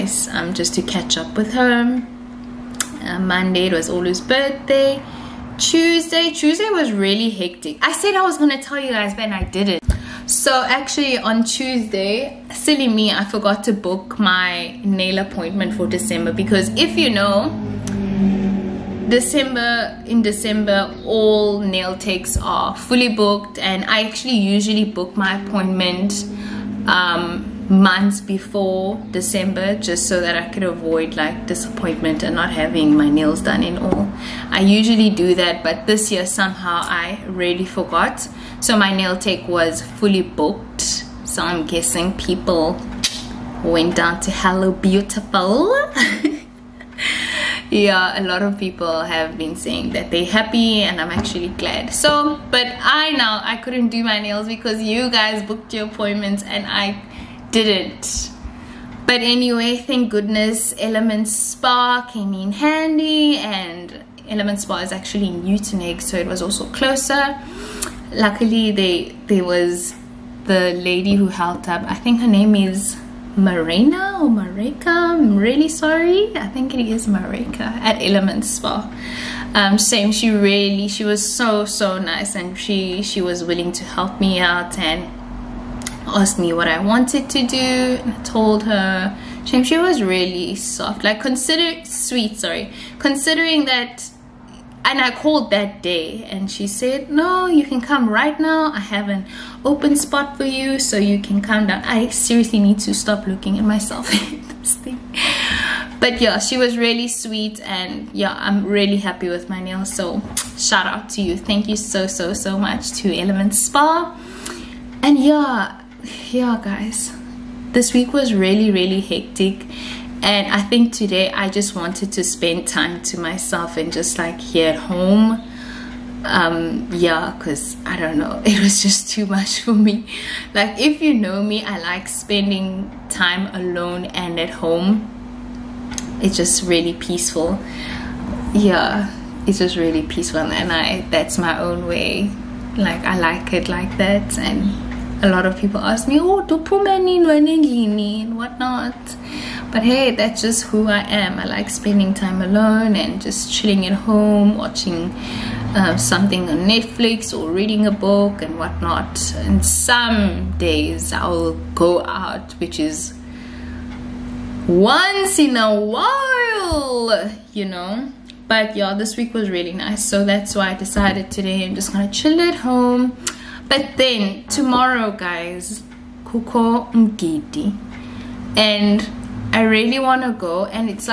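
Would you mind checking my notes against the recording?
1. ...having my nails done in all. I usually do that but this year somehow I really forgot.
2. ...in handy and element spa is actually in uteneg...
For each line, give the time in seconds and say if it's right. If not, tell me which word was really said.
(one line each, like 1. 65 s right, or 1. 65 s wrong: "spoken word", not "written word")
1. 32 s right
2. 62 s right.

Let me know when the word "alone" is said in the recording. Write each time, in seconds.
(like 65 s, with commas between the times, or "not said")
133 s, 152 s.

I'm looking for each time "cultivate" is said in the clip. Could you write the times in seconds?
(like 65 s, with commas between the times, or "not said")
not said.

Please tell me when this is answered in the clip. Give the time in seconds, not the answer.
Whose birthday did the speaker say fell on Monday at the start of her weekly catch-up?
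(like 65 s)
3 s.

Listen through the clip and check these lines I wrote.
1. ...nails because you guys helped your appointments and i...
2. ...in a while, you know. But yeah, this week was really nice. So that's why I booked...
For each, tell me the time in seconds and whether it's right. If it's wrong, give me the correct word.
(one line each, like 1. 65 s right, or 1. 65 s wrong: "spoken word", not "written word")
1. 54 s wrong: "booked", not "helped"
2. 165 s wrong: "decided", not "booked".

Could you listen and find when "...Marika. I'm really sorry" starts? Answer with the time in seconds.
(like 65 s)
74 s.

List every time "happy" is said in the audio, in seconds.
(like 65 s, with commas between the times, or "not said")
50 s, 108 s.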